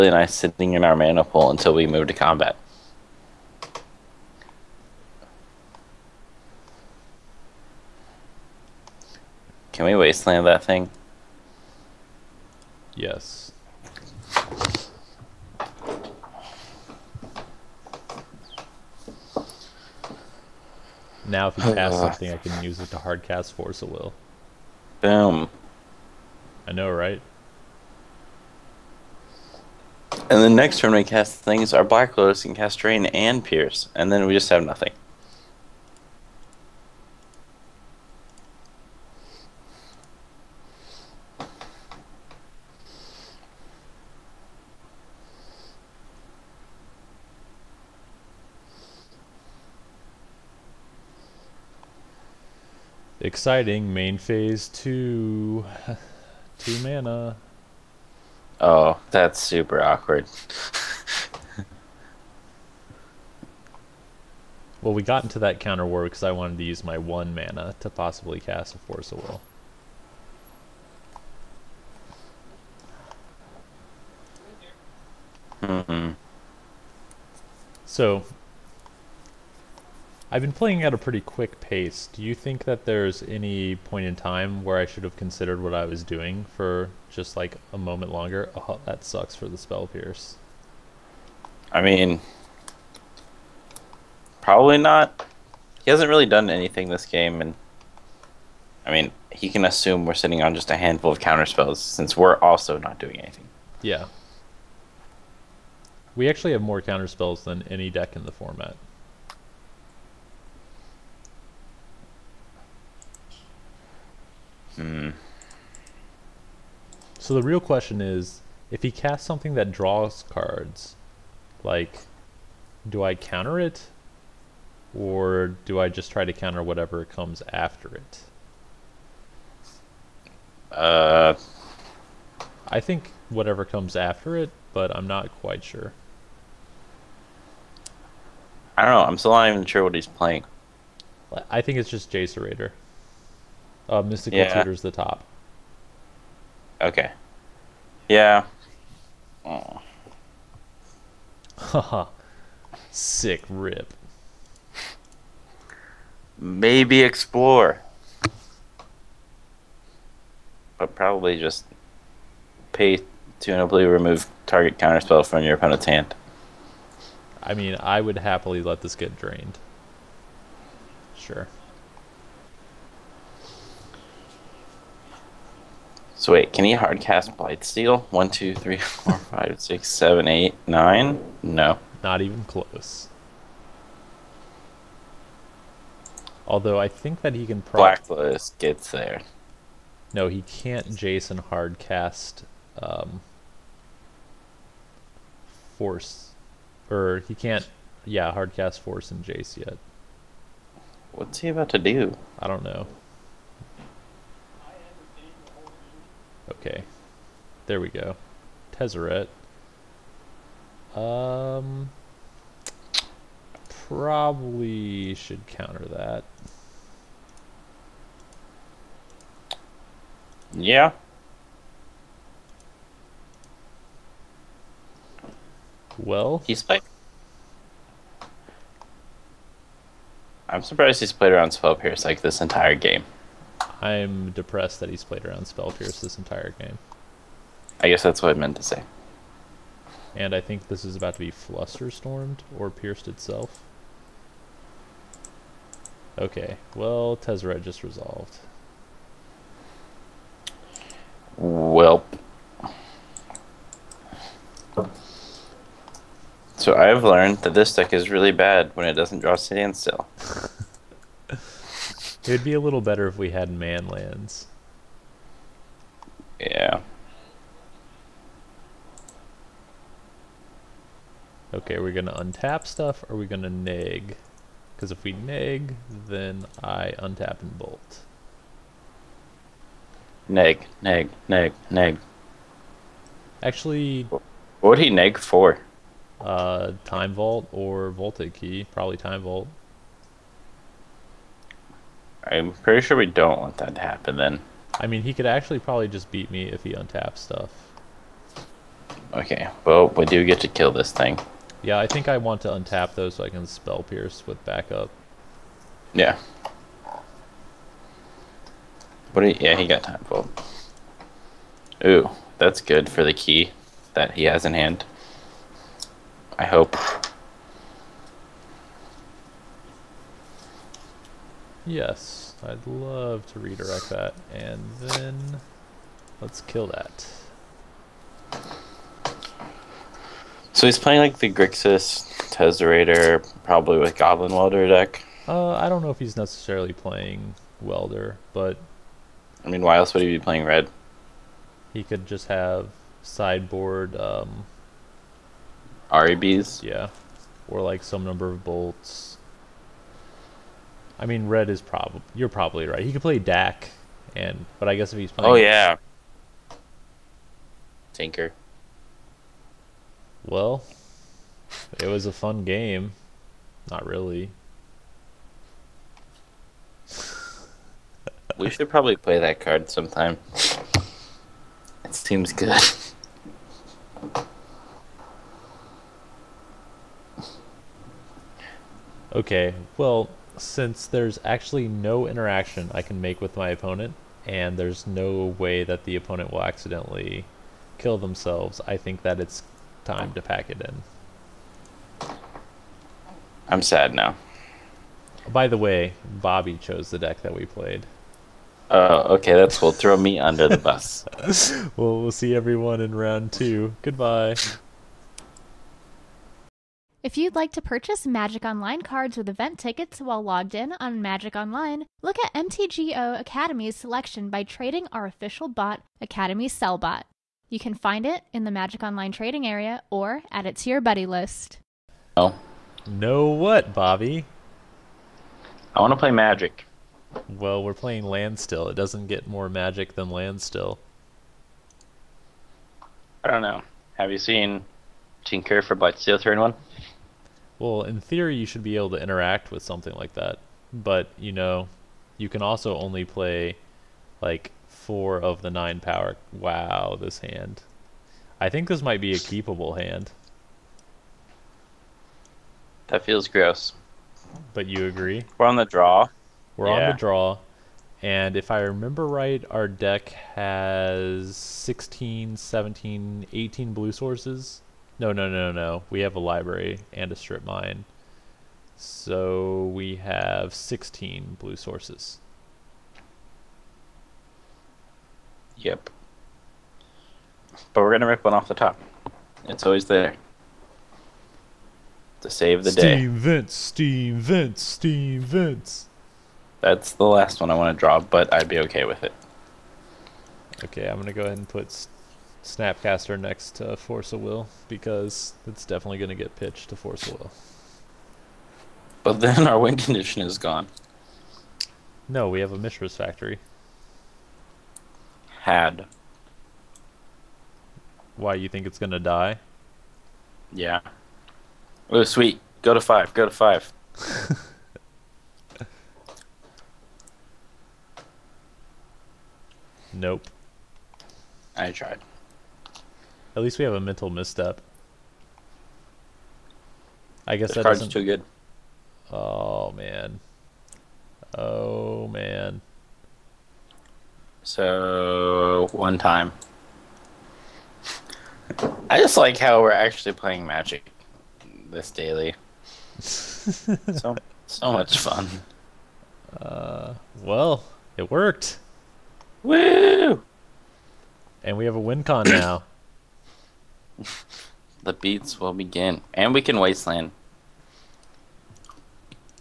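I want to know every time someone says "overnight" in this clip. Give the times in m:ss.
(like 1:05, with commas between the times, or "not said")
not said.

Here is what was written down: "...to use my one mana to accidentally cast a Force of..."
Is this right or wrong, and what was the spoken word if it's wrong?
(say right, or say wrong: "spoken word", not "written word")
wrong: "possibly", not "accidentally".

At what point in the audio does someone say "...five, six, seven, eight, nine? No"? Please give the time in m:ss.
2:59.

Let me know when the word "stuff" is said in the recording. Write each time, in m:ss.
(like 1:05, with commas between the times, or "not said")
4:32, 4:57.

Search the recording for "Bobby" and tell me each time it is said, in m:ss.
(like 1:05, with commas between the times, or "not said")
6:36, 7:03.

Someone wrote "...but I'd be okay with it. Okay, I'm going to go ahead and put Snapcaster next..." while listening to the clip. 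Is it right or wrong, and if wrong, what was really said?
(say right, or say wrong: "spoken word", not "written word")
right.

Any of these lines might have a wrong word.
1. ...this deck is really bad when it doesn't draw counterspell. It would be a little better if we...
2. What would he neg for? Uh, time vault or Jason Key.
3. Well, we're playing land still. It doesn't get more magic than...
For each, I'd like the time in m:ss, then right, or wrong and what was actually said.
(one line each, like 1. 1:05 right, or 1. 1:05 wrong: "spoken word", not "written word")
1. 4:17 wrong: "standstill", not "counterspell"
2. 4:44 wrong: "Voltaic", not "Jason"
3. 7:07 right.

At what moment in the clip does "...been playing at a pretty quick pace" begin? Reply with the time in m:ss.
1:20.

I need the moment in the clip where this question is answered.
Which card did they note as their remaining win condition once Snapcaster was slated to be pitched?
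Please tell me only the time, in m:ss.
8:22.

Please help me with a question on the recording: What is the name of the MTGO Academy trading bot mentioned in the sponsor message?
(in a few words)
Academy Sellbot.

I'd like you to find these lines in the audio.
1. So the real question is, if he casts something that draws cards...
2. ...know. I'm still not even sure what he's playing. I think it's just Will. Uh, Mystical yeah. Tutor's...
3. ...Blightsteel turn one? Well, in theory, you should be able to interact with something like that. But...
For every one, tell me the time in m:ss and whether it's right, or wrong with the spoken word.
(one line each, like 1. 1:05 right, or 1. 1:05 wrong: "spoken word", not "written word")
1. 1:57 right
2. 2:18 wrong: "Raider", not "Will"
3. 7:15 right.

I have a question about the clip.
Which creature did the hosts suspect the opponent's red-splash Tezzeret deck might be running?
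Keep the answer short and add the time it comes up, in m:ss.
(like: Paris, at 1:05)
Goblin Welder, at 5:33.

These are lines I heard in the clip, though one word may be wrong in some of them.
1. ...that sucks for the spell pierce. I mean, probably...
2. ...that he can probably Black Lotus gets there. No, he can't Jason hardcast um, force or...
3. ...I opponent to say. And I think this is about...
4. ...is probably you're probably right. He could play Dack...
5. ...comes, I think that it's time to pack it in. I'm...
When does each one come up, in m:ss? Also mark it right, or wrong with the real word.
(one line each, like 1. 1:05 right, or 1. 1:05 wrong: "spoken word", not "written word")
1. 1:28 right
2. 3:07 right
3. 3:58 wrong: "meant", not "opponent"
4. 5:51 right
5. 6:27 wrong: "themselves", not "comes".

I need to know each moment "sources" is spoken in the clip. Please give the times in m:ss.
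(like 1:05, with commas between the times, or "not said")
7:43, 7:51.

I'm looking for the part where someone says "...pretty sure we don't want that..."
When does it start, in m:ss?
4:52.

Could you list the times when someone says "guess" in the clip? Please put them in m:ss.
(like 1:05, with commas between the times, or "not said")
3:57, 5:54, 8:47.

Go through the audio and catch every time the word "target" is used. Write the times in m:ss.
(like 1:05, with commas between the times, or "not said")
2:44.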